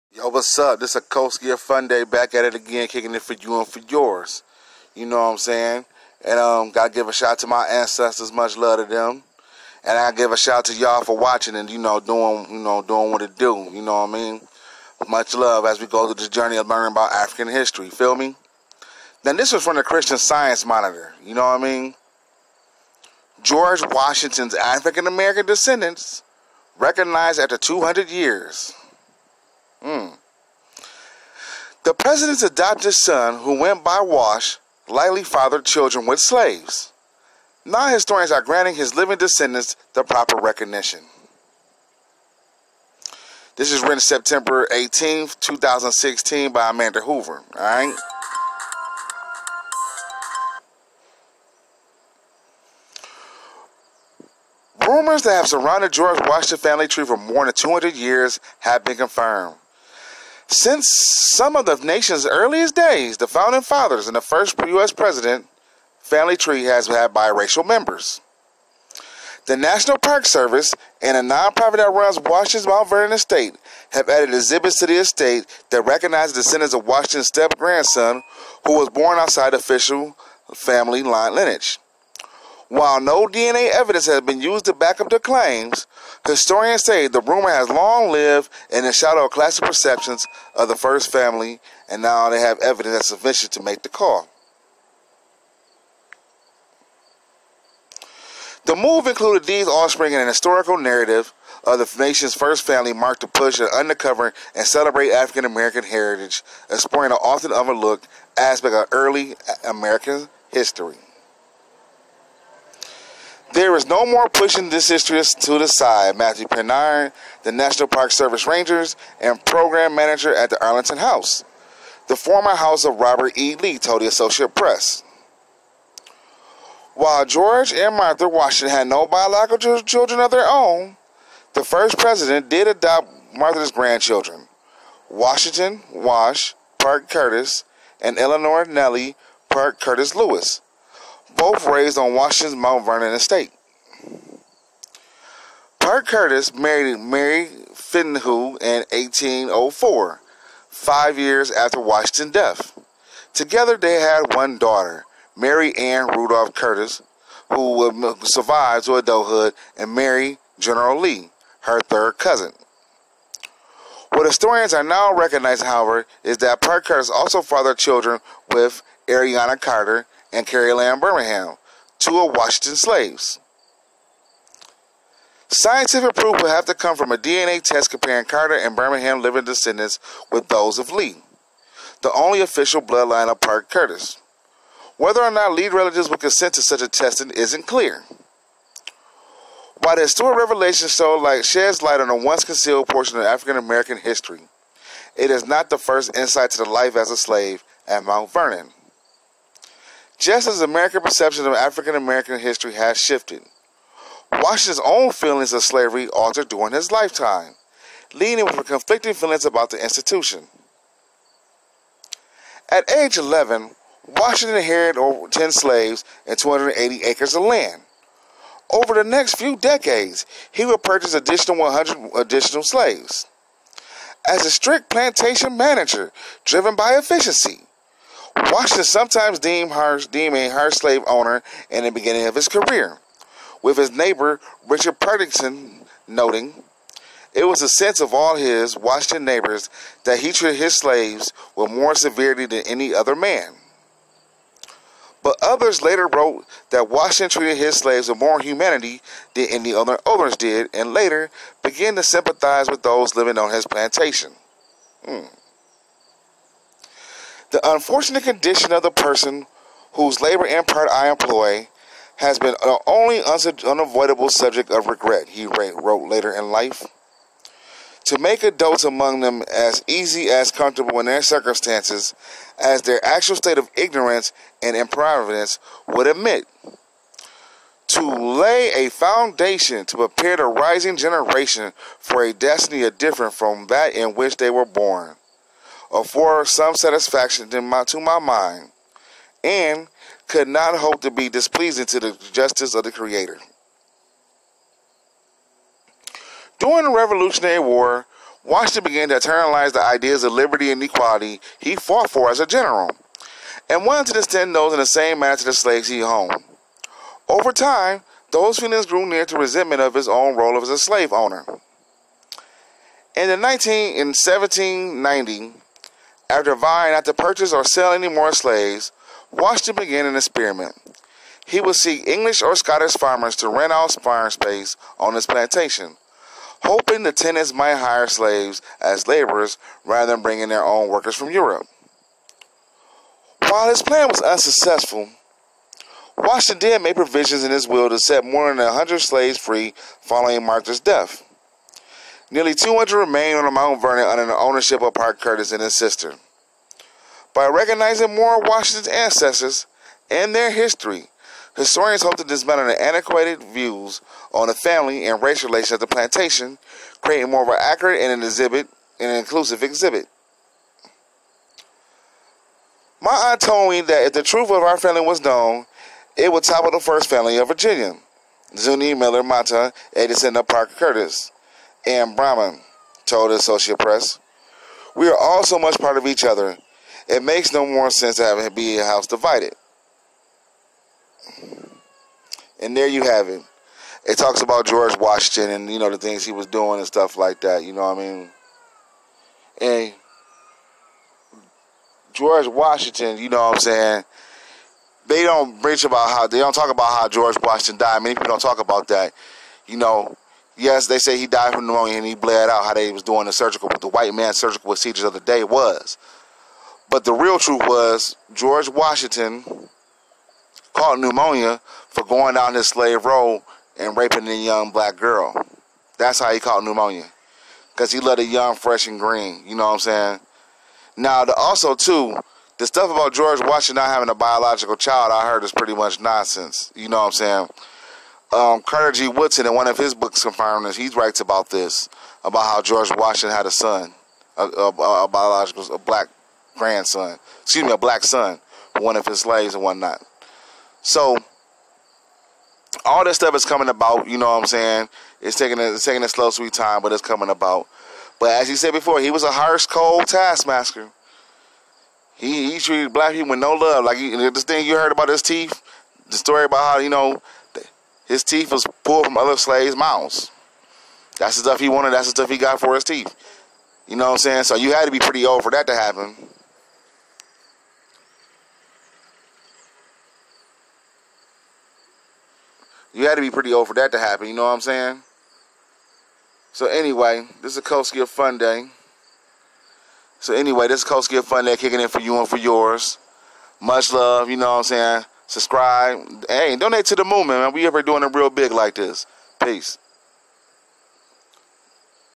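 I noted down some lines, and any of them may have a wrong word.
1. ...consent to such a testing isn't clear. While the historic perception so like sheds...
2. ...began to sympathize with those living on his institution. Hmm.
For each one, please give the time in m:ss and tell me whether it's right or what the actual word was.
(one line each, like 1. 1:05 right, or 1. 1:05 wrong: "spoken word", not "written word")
1. 3:06 wrong: "revelation", not "perception"
2. 4:11 wrong: "plantation", not "institution".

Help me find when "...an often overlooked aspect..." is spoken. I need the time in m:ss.
1:47.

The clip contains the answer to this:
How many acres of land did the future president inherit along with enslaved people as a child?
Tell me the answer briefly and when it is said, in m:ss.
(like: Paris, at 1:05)
280, at 3:36.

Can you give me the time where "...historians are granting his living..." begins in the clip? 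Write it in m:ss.
0:37.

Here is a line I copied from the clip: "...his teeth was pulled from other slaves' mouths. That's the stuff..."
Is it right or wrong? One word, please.
right.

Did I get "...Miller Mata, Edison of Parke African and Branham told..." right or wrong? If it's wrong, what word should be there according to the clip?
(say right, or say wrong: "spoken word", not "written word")
wrong: "Custis", not "African".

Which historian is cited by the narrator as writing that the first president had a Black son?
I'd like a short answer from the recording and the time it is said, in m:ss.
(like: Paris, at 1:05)
Carter G. Woodson, at 7:08.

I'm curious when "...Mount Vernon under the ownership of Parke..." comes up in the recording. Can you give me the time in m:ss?
5:43.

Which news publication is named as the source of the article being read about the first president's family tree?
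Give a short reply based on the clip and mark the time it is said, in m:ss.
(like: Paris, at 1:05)
Christian Science Monitor, at 0:19.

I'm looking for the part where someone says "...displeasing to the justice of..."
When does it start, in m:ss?
4:51.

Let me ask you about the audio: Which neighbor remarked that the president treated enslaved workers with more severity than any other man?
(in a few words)
Richard Parkinson.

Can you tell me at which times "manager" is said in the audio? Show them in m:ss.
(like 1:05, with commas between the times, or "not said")
1:59, 3:45.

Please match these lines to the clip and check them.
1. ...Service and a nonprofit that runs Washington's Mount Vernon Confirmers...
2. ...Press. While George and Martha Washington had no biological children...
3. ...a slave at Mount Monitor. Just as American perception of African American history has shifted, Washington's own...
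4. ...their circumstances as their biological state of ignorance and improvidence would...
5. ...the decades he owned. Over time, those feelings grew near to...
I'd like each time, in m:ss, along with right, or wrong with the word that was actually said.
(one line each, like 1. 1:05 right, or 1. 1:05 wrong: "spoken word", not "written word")
1. 1:10 wrong: "Estate", not "Confirmers"
2. 2:04 right
3. 3:17 wrong: "Vernon", not "Monitor"
4. 4:31 wrong: "actual", not "biological"
5. 5:05 wrong: "slaves", not "decades".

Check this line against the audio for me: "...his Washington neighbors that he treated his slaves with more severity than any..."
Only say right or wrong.
right.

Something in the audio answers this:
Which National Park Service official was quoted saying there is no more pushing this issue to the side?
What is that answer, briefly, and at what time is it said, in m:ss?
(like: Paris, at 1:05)
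Matthew Penrod, at 1:56.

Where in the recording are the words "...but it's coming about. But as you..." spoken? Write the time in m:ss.
7:26.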